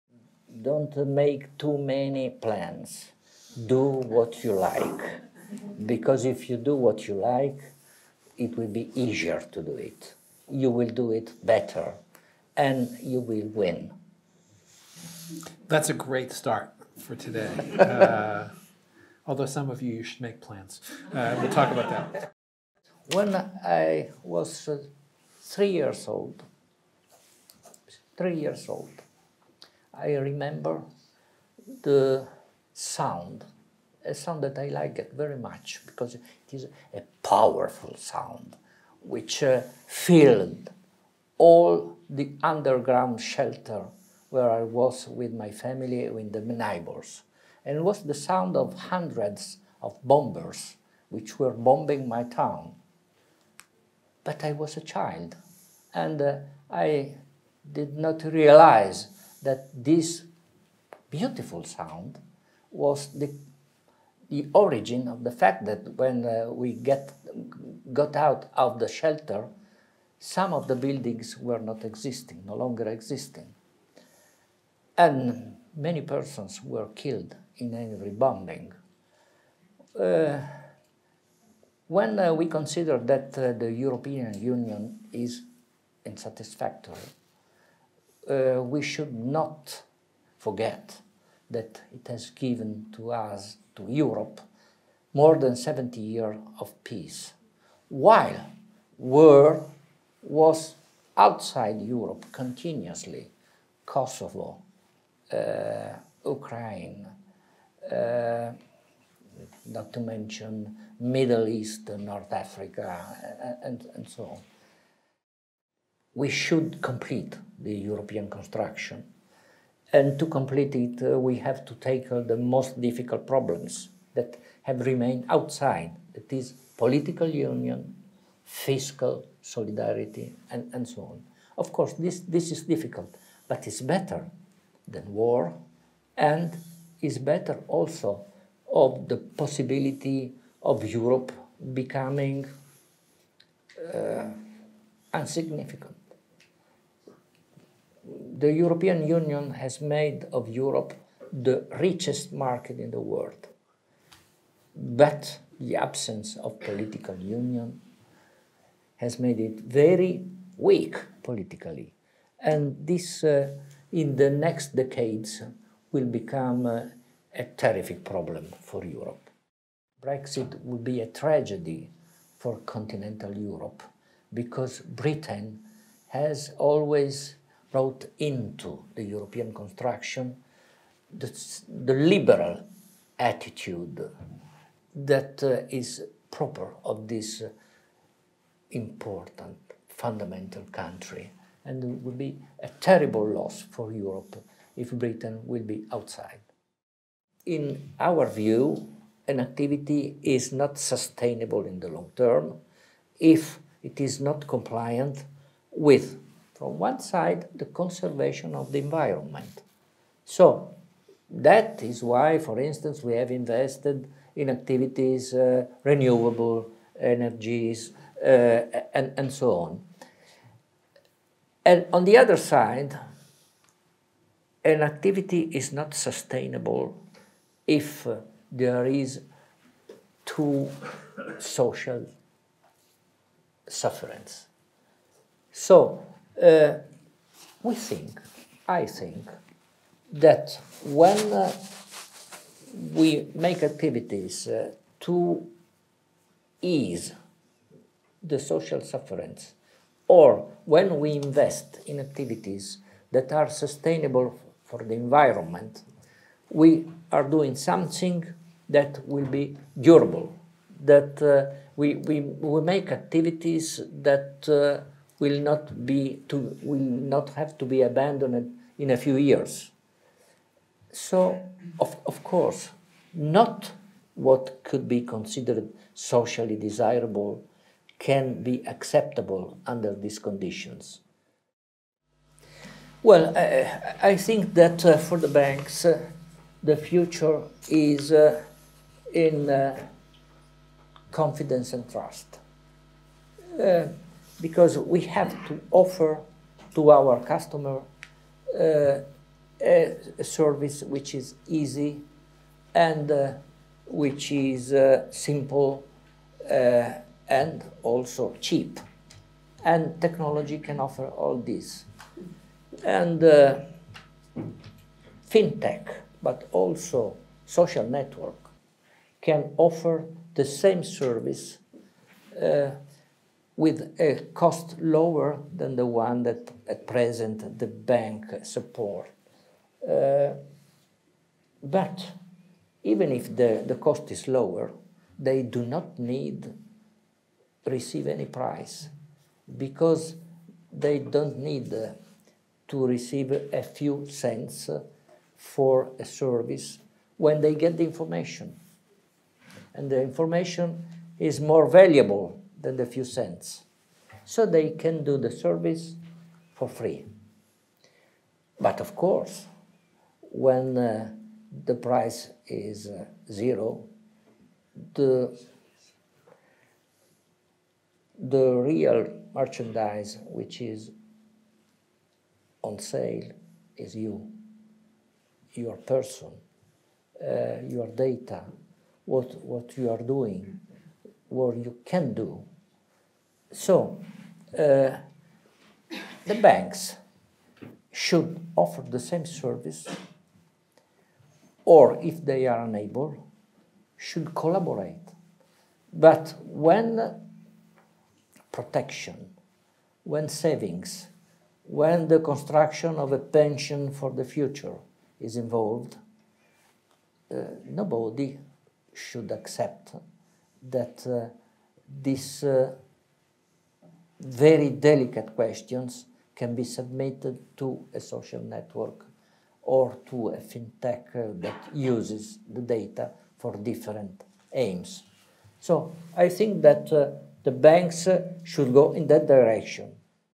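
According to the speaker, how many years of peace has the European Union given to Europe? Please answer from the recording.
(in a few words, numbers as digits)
More than 70 years.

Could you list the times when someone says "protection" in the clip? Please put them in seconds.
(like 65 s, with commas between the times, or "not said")
398 s.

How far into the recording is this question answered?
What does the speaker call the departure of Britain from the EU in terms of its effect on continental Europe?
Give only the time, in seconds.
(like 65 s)
171 s.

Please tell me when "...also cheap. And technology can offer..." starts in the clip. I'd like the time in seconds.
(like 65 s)
307 s.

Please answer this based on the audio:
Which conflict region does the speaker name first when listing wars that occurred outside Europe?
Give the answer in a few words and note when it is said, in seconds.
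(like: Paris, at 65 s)
Kosovo, at 103 s.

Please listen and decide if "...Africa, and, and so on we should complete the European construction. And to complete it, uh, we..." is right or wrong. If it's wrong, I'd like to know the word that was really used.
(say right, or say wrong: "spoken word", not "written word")
right.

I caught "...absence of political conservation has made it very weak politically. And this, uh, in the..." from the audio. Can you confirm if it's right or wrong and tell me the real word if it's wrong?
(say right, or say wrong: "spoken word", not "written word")
wrong: "union", not "conservation".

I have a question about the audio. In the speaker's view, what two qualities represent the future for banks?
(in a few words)
Confidence and trust.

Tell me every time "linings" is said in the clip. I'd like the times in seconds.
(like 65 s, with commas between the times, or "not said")
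not said.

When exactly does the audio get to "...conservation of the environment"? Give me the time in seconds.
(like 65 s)
207 s.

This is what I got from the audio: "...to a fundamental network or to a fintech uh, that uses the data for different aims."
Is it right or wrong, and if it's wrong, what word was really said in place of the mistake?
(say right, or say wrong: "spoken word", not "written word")
wrong: "social", not "fundamental".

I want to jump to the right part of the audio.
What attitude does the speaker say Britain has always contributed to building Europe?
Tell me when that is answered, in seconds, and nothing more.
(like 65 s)
181 s.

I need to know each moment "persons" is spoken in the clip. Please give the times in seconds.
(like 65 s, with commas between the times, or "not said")
76 s, 375 s.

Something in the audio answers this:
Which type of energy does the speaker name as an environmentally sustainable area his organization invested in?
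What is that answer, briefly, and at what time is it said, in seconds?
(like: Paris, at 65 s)
Renewable energies, at 215 s.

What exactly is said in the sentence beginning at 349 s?
And the information is more valuable than the few cents.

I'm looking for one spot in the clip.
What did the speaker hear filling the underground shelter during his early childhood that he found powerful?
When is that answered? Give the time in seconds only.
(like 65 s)
48 s.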